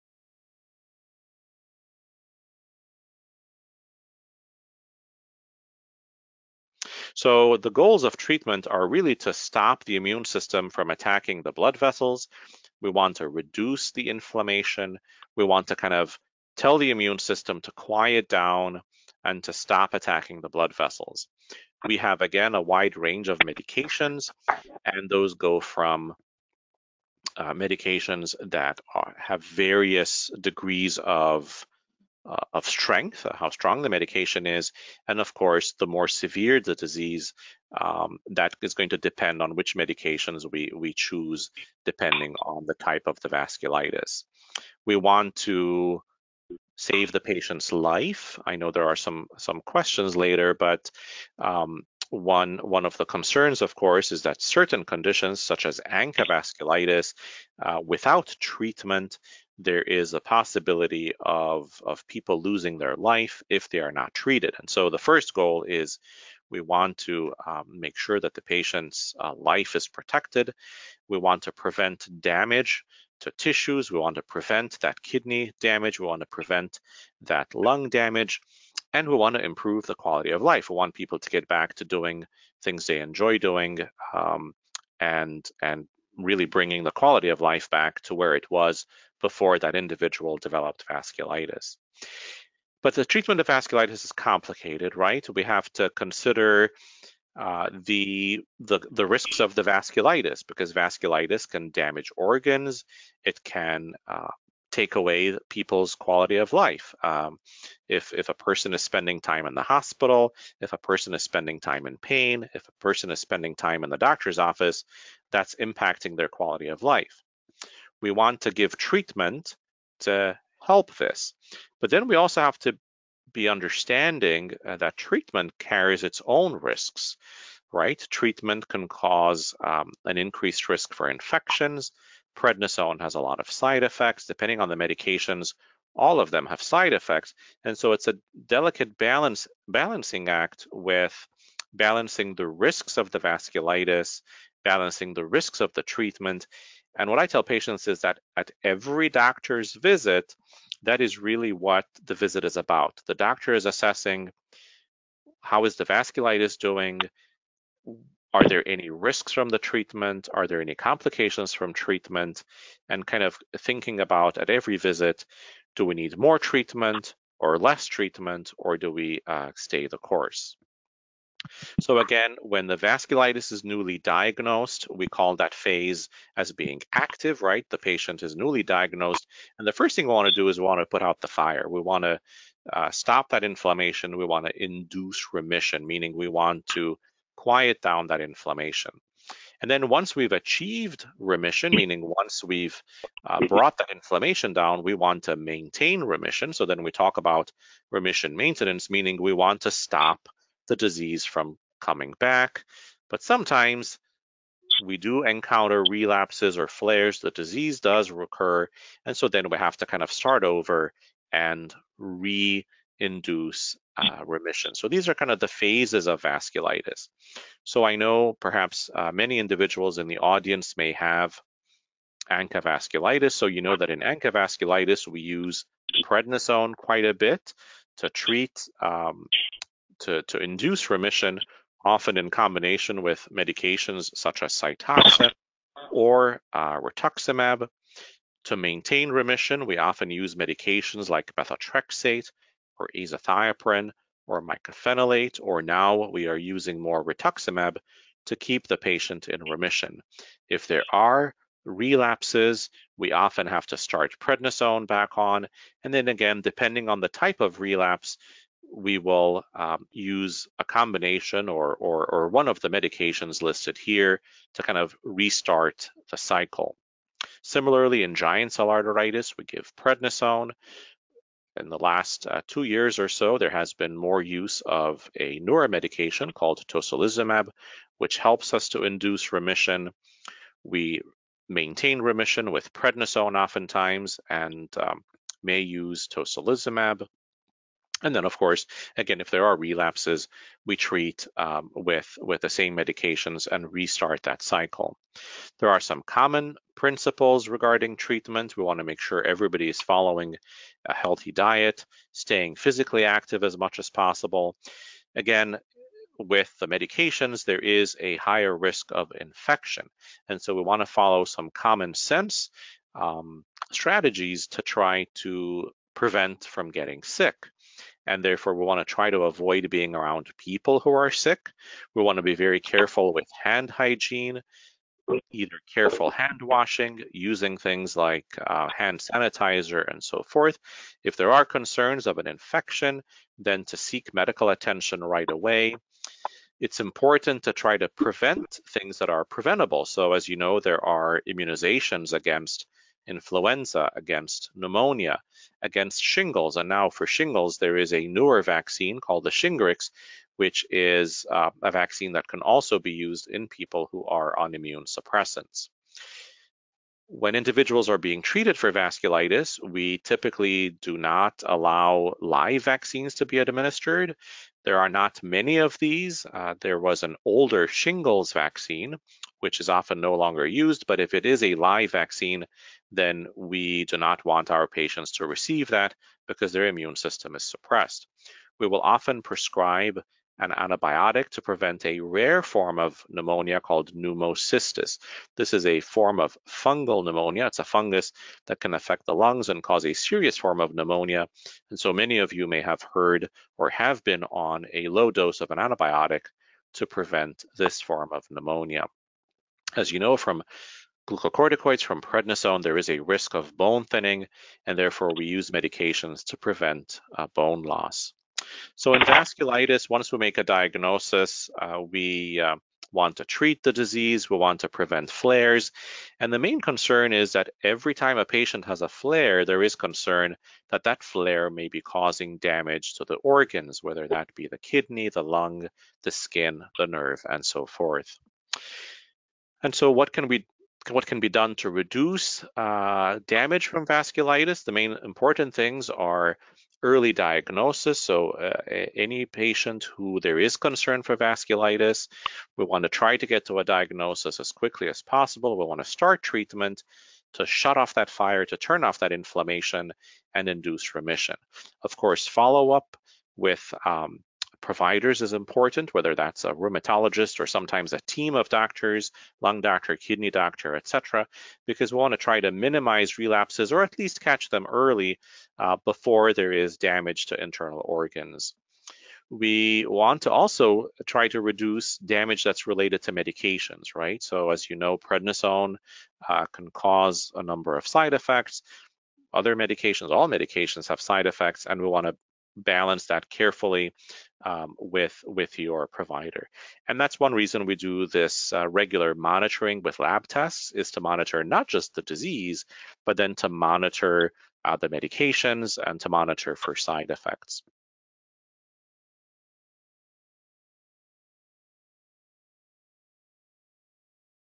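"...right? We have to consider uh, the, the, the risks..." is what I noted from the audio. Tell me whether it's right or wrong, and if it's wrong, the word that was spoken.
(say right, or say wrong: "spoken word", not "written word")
right.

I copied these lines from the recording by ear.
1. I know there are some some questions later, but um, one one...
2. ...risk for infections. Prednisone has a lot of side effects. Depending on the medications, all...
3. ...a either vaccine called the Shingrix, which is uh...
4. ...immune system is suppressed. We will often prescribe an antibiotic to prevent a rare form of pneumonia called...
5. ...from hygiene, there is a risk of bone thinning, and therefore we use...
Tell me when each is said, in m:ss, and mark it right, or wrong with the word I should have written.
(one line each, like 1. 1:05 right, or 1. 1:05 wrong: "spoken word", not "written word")
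1. 0:48 right
2. 2:10 right
3. 5:47 wrong: "newer", not "either"
4. 6:16 right
5. 6:41 wrong: "prednisone", not "hygiene".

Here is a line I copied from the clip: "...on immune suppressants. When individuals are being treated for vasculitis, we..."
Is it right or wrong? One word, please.
right.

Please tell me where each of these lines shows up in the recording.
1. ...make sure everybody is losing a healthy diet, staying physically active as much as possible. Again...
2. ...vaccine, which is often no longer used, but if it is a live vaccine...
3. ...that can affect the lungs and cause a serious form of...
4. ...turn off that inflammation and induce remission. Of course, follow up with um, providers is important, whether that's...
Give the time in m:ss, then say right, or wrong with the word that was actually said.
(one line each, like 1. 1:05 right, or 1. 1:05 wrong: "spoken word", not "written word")
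1. 4:58 wrong: "following", not "losing"
2. 6:08 right
3. 6:28 right
4. 7:28 right.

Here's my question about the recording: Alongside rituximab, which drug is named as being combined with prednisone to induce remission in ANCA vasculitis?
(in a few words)
Cytoxan.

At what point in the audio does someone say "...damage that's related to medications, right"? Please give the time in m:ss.
7:51.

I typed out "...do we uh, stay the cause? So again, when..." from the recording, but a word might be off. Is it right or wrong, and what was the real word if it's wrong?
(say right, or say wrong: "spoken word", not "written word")
wrong: "course", not "cause".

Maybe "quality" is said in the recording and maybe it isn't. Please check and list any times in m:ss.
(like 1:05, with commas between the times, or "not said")
1:19, 1:26, 1:45, 1:56.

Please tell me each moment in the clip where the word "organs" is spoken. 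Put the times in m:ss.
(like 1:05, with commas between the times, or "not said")
1:42, 7:03, 7:47.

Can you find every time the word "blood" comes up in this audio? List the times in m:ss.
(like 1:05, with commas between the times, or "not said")
0:11, 0:20.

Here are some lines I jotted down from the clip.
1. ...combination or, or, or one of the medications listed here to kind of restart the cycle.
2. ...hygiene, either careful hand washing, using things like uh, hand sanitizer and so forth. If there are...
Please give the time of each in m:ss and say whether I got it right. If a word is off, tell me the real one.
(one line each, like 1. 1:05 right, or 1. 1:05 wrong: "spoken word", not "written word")
1. 4:20 right
2. 5:23 right.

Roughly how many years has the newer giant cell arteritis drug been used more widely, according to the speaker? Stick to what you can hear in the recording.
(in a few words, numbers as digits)
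2.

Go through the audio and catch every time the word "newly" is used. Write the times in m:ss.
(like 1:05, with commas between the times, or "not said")
2:53, 2:58.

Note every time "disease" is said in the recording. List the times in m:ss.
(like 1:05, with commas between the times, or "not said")
0:36, 3:20, 3:27, 6:53, 8:12.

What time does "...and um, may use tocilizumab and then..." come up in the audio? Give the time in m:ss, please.
4:44.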